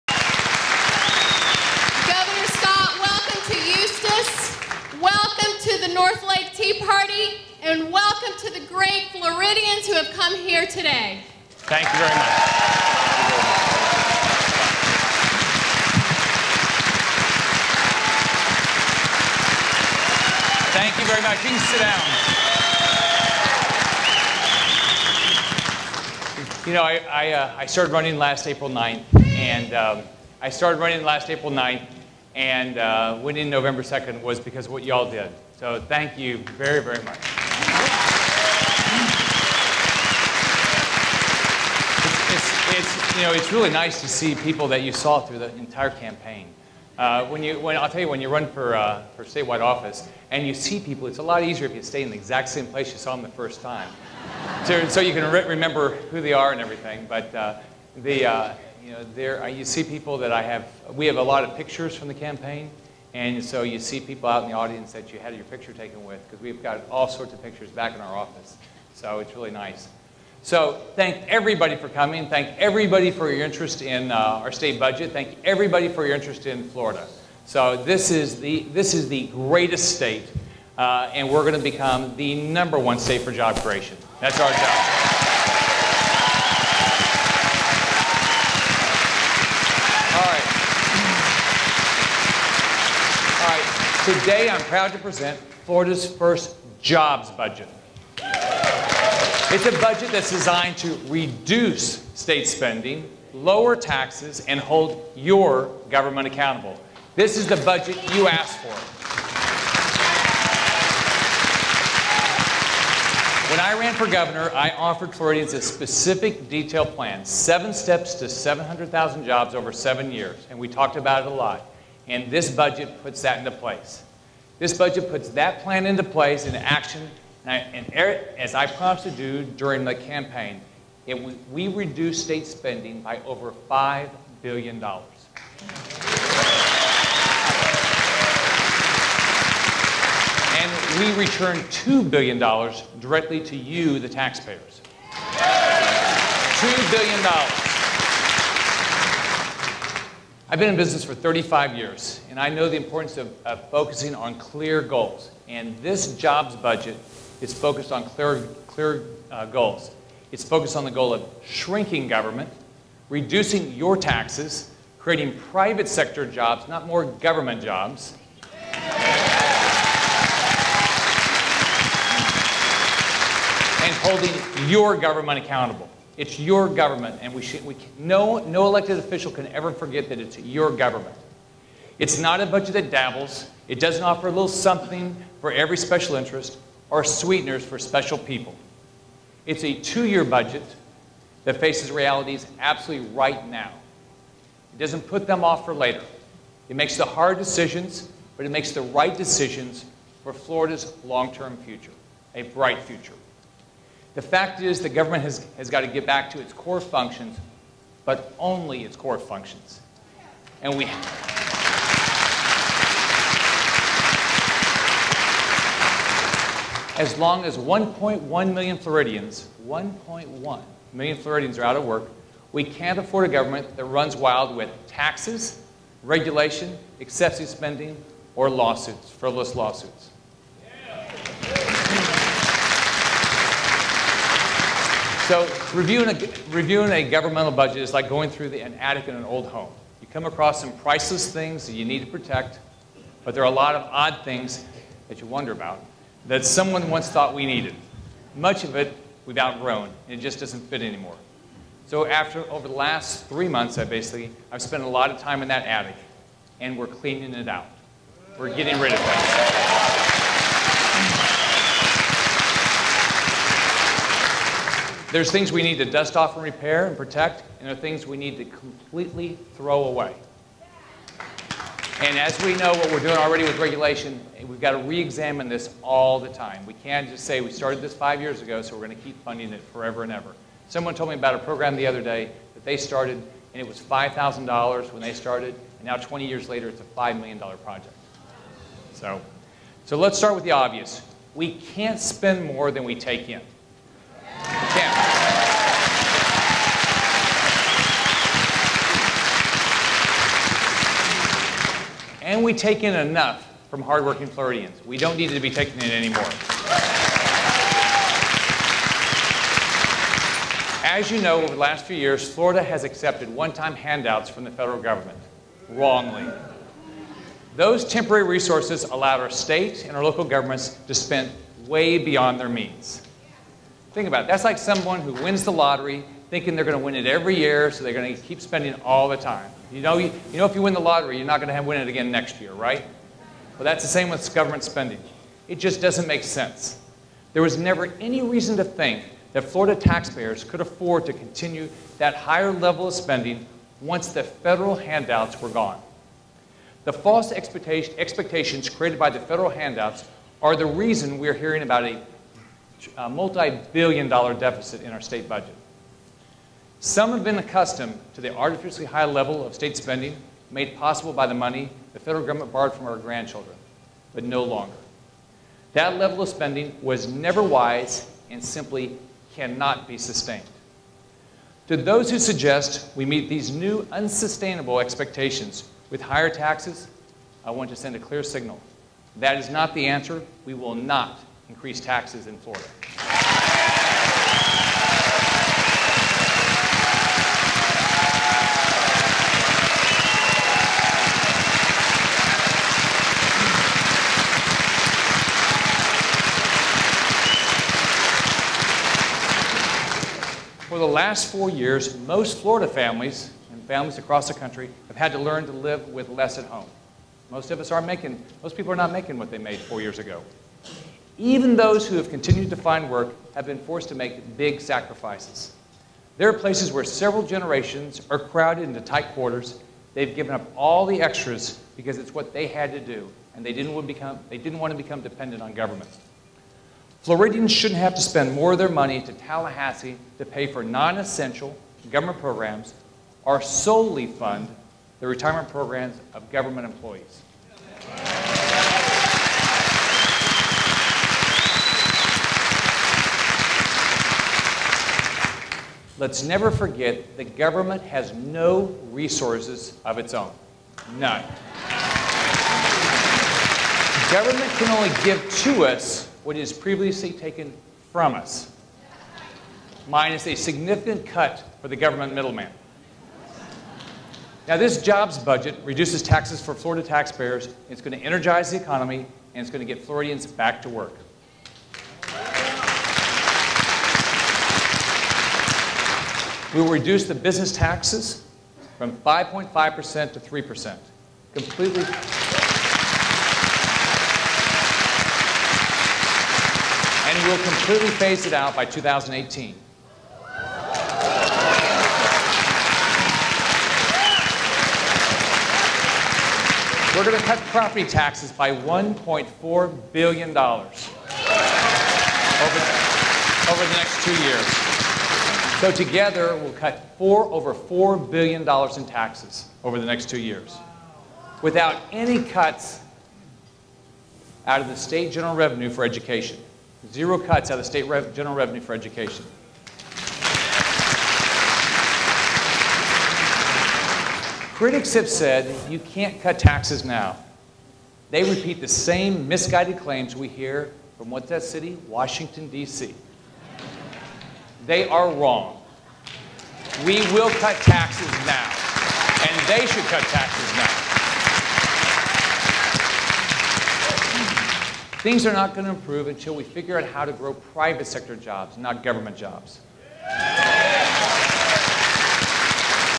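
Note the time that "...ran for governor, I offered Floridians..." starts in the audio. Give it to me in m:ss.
1:53.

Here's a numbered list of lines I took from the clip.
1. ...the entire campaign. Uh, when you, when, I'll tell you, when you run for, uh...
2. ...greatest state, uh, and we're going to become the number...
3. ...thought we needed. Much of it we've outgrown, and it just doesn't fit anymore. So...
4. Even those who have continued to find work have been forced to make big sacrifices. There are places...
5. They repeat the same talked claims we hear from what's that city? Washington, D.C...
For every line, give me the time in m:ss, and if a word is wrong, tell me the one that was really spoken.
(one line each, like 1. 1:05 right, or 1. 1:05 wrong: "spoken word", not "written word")
1. 0:45 right
2. 1:19 right
3. 4:07 right
4. 6:51 right
5. 8:48 wrong: "misguided", not "talked".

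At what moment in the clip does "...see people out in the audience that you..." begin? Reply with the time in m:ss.
1:03.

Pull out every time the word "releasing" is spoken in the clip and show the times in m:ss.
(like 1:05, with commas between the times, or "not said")
not said.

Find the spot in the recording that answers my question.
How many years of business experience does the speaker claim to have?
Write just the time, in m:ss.
2:31.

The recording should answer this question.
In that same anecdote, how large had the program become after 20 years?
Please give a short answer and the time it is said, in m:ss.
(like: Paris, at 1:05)
$5 million, at 4:46.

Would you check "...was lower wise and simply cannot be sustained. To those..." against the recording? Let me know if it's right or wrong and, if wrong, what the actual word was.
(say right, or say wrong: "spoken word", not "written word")
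wrong: "never", not "lower".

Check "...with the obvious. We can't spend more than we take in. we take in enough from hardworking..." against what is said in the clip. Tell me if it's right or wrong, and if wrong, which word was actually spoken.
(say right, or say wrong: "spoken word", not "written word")
right.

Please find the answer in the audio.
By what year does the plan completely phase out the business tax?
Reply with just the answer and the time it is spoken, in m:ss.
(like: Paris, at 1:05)
2018, at 8:08.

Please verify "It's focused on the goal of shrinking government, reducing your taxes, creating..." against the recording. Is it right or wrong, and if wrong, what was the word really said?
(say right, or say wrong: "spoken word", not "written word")
right.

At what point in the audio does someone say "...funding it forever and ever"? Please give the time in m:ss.
4:39.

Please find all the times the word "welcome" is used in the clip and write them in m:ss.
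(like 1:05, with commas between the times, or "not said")
0:07.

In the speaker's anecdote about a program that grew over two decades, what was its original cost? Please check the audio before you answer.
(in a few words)
$5,000.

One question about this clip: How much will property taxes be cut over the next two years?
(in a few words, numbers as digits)
$1.4 billion.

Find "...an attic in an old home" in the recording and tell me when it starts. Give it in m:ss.
3:58.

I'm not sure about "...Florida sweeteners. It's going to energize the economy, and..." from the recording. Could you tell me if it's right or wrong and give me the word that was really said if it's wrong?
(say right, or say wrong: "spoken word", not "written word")
wrong: "taxpayers", not "sweeteners".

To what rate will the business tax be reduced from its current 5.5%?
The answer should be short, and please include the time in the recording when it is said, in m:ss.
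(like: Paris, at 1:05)
3%, at 8:00.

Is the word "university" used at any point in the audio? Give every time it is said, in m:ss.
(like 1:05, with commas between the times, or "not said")
not said.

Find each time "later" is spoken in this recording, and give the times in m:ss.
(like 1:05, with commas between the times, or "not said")
3:15, 4:46.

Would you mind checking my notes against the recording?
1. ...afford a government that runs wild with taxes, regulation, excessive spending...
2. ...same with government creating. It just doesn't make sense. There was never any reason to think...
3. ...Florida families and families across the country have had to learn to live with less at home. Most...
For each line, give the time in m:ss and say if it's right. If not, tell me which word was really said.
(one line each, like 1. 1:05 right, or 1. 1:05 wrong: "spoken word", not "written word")
1. 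3:42 right
2. 5:33 wrong: "spending", not "creating"
3. 6:42 right.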